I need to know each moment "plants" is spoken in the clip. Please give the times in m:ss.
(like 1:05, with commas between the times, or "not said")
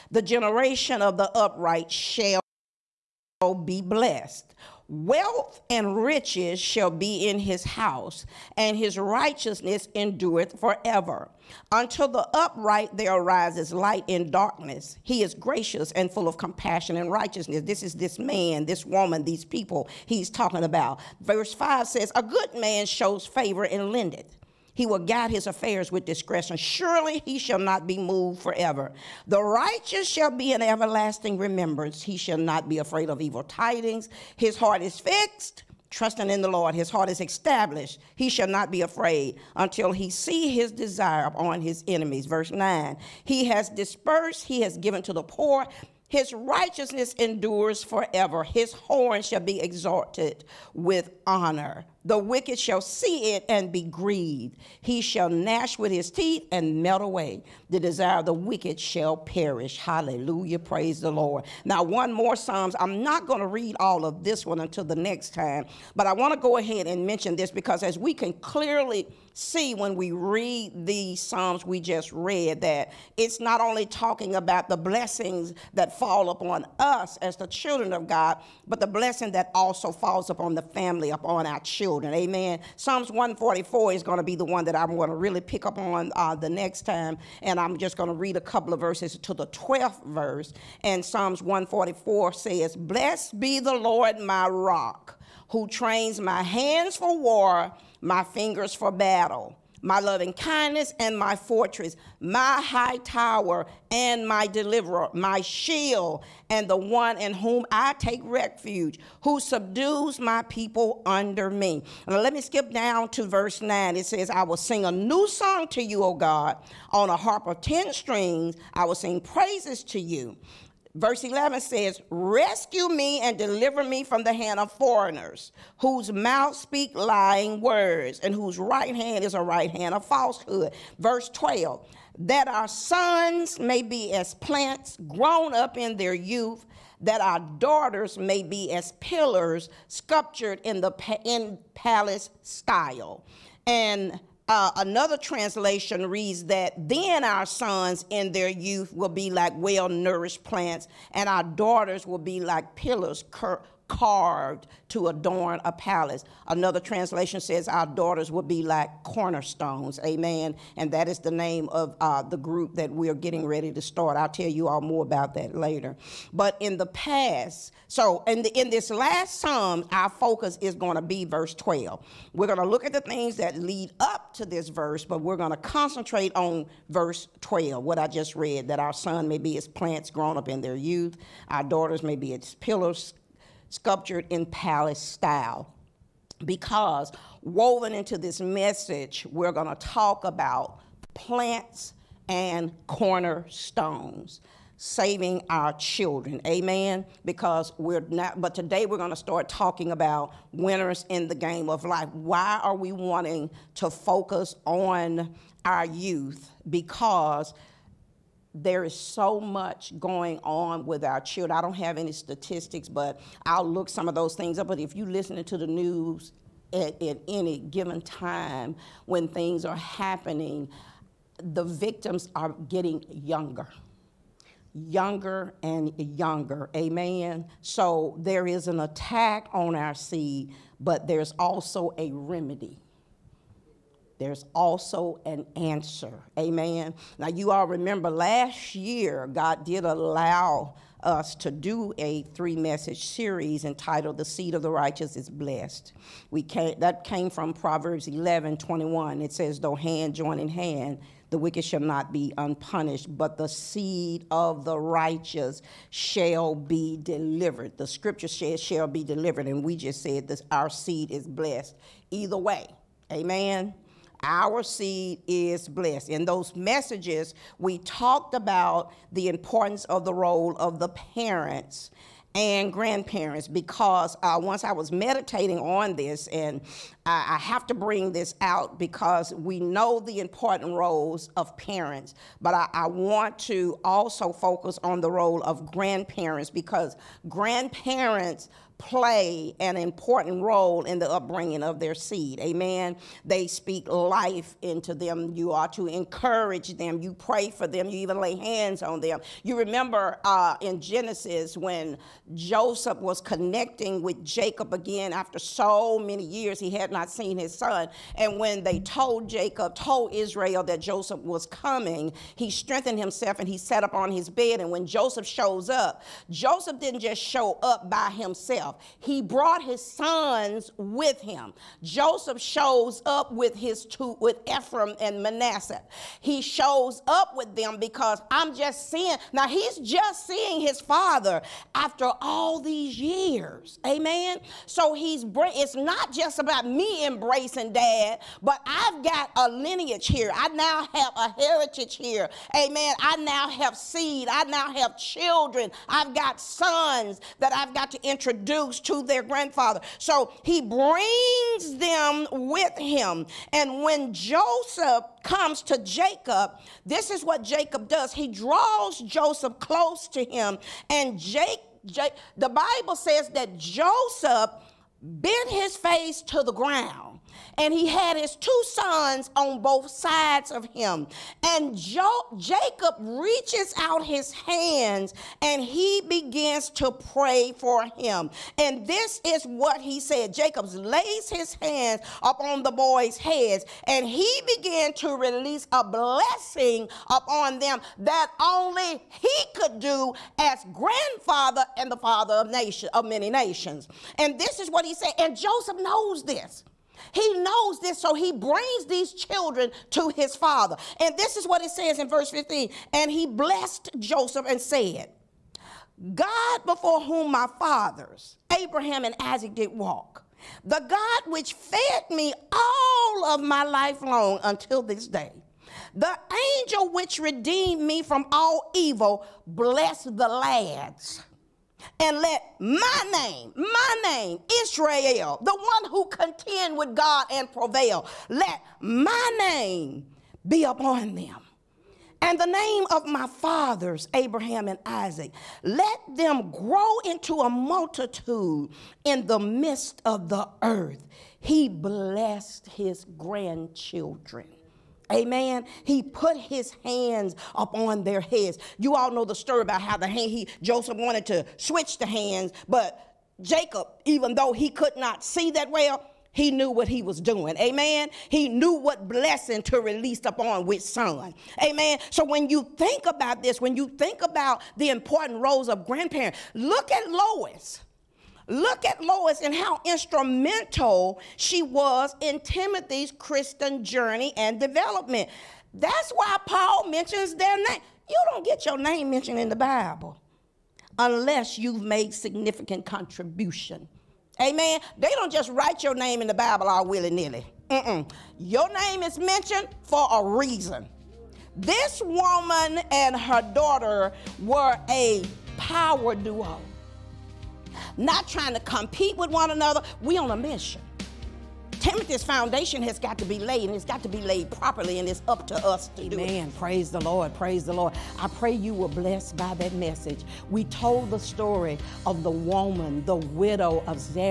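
2:14, 2:30, 2:59, 3:11.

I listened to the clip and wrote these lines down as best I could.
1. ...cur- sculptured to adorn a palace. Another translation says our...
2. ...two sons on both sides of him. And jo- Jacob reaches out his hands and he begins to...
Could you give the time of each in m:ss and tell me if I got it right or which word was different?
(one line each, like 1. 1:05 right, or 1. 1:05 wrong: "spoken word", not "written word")
1. 2:33 wrong: "carved", not "sculptured"
2. 6:08 right.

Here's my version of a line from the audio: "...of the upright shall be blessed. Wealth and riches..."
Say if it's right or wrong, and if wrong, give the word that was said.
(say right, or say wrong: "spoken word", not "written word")
right.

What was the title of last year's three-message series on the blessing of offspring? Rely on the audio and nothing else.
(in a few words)
The Seed of the Righteous is Blessed.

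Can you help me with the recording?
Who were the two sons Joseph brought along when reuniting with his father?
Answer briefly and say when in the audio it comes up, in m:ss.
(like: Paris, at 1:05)
Ephraim and Manasseh, at 5:24.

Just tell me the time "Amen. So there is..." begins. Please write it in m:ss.
3:46.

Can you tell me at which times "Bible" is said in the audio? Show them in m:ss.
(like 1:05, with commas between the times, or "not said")
6:02, 7:59, 8:06.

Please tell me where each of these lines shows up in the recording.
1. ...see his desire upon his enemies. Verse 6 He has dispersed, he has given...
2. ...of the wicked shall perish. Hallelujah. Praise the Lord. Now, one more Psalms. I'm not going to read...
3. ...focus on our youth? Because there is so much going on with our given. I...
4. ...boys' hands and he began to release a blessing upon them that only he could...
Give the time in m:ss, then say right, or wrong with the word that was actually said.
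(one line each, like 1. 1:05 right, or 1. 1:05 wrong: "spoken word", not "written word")
1. 0:40 wrong: "9", not "6"
2. 0:58 right
3. 3:23 wrong: "children", not "given"
4. 6:22 wrong: "heads", not "hands".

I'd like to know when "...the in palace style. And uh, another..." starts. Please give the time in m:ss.
2:20.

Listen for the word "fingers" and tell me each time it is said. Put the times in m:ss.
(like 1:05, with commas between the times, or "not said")
1:38.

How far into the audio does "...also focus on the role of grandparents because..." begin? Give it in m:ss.
4:43.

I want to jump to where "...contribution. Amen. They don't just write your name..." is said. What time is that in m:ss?
8:02.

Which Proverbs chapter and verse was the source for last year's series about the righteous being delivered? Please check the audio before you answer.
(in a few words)
Proverbs 11:21.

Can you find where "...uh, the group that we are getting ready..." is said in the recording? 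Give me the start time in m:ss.
2:41.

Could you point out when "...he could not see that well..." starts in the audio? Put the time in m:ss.
7:34.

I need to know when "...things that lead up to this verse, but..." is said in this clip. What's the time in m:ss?
2:53.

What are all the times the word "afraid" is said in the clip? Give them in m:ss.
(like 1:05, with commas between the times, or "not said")
0:32, 0:38.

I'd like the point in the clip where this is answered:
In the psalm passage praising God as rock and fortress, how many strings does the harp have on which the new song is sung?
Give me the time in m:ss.
1:57.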